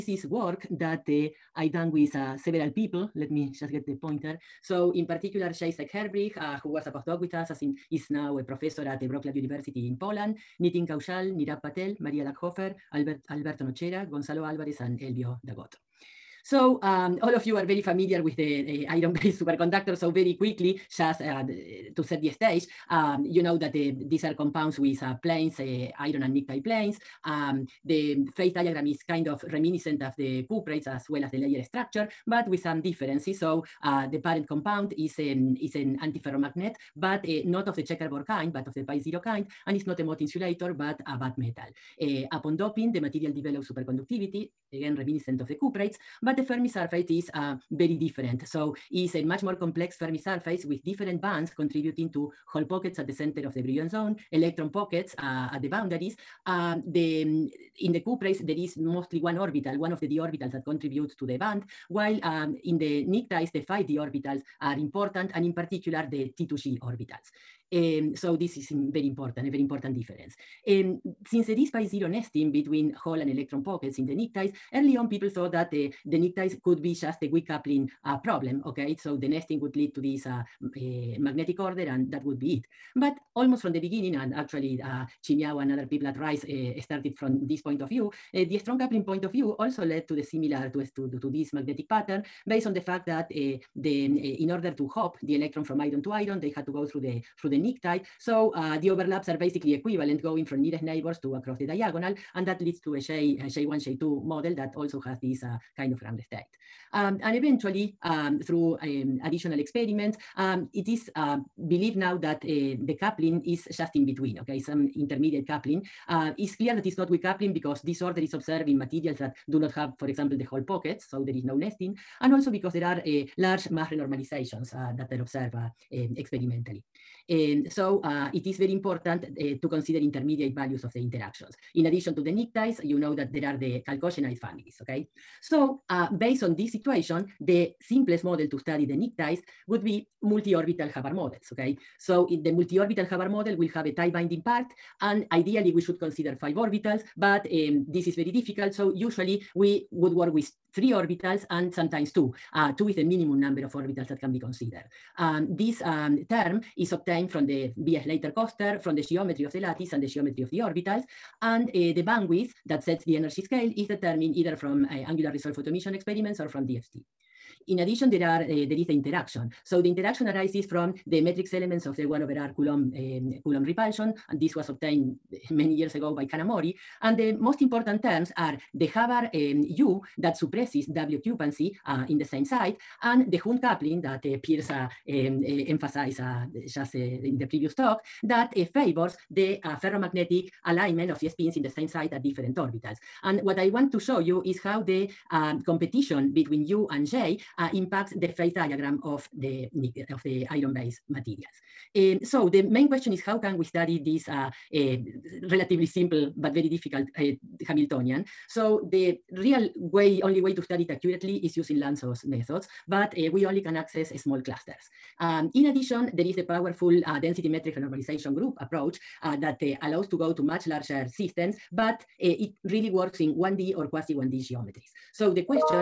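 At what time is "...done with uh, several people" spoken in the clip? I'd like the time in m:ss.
0:01.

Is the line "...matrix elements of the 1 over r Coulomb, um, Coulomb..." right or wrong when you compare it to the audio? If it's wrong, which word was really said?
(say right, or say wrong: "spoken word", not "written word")
right.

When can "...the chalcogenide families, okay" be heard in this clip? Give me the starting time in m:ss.
2:13.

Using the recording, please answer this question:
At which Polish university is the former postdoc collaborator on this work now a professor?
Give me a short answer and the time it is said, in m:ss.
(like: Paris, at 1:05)
Wroclaw University, at 0:09.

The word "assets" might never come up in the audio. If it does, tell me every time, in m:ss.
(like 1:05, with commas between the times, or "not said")
not said.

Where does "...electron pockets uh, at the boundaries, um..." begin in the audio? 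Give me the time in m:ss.
0:54.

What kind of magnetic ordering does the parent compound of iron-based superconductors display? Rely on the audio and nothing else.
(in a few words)
pi zero.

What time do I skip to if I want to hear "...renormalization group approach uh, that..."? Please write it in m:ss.
3:37.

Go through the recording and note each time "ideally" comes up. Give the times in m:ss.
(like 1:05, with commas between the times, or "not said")
2:25.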